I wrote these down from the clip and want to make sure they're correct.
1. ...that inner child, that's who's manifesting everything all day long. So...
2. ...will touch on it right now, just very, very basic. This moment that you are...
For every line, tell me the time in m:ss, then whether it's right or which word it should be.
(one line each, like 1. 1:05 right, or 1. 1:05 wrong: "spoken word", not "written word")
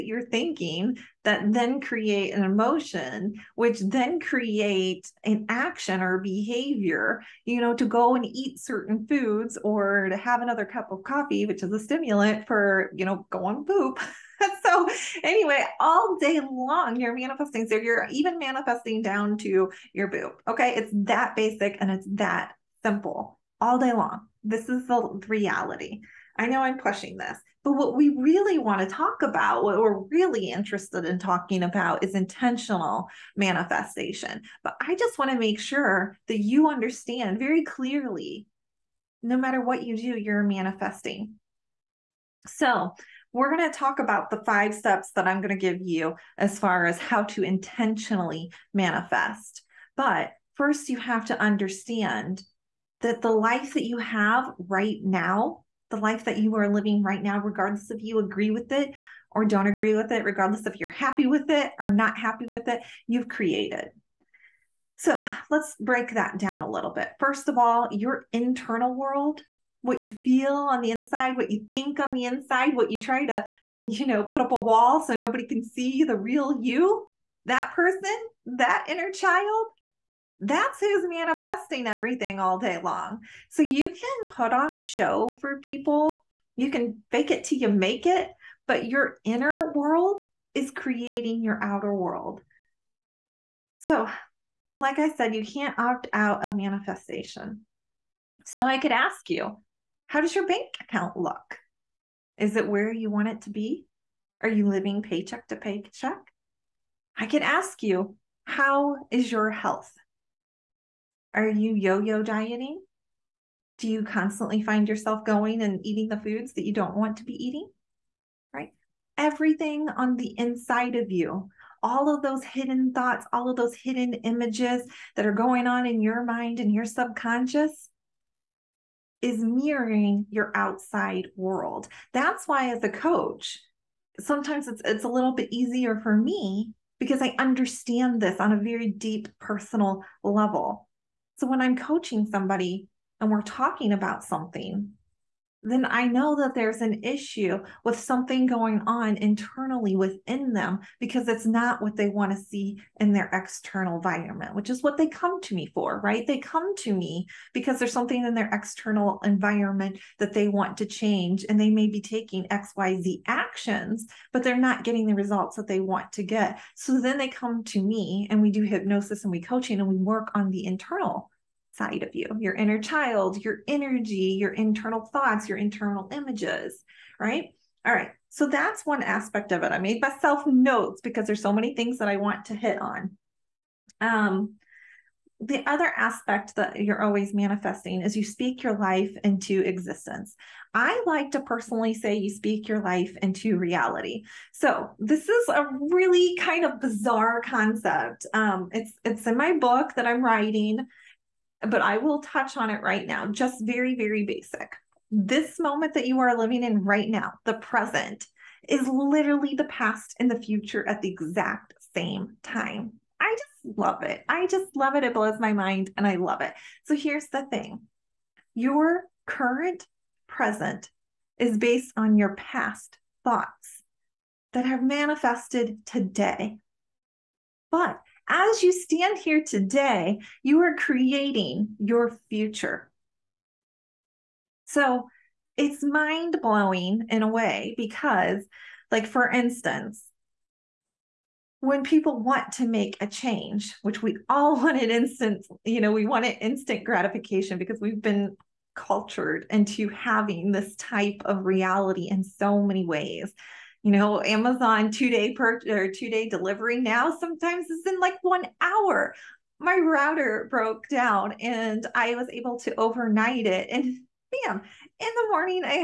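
1. 1:18 right
2. 3:21 right.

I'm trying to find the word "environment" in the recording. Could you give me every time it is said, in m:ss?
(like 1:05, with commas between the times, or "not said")
2:33, 2:39.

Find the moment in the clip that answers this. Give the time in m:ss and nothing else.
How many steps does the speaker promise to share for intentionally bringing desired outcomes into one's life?
0:44.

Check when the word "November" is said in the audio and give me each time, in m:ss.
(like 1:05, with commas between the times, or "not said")
not said.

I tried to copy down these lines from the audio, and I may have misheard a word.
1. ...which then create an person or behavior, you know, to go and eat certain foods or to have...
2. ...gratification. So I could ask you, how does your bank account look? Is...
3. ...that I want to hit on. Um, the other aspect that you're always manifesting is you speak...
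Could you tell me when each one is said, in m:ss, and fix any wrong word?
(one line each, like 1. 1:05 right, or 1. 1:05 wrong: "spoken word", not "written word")
1. 0:03 wrong: "action", not "person"
2. 1:36 wrong: "manifestation", not "gratification"
3. 3:01 right.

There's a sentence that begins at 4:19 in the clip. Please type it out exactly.
My router broke down and I was able to overnight it.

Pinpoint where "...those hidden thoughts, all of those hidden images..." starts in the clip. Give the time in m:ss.
2:02.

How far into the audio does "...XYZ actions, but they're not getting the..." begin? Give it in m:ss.
2:42.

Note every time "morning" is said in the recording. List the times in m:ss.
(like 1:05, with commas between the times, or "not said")
4:25.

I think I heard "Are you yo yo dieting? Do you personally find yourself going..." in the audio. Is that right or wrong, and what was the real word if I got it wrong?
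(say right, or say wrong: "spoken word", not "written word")
wrong: "constantly", not "personally".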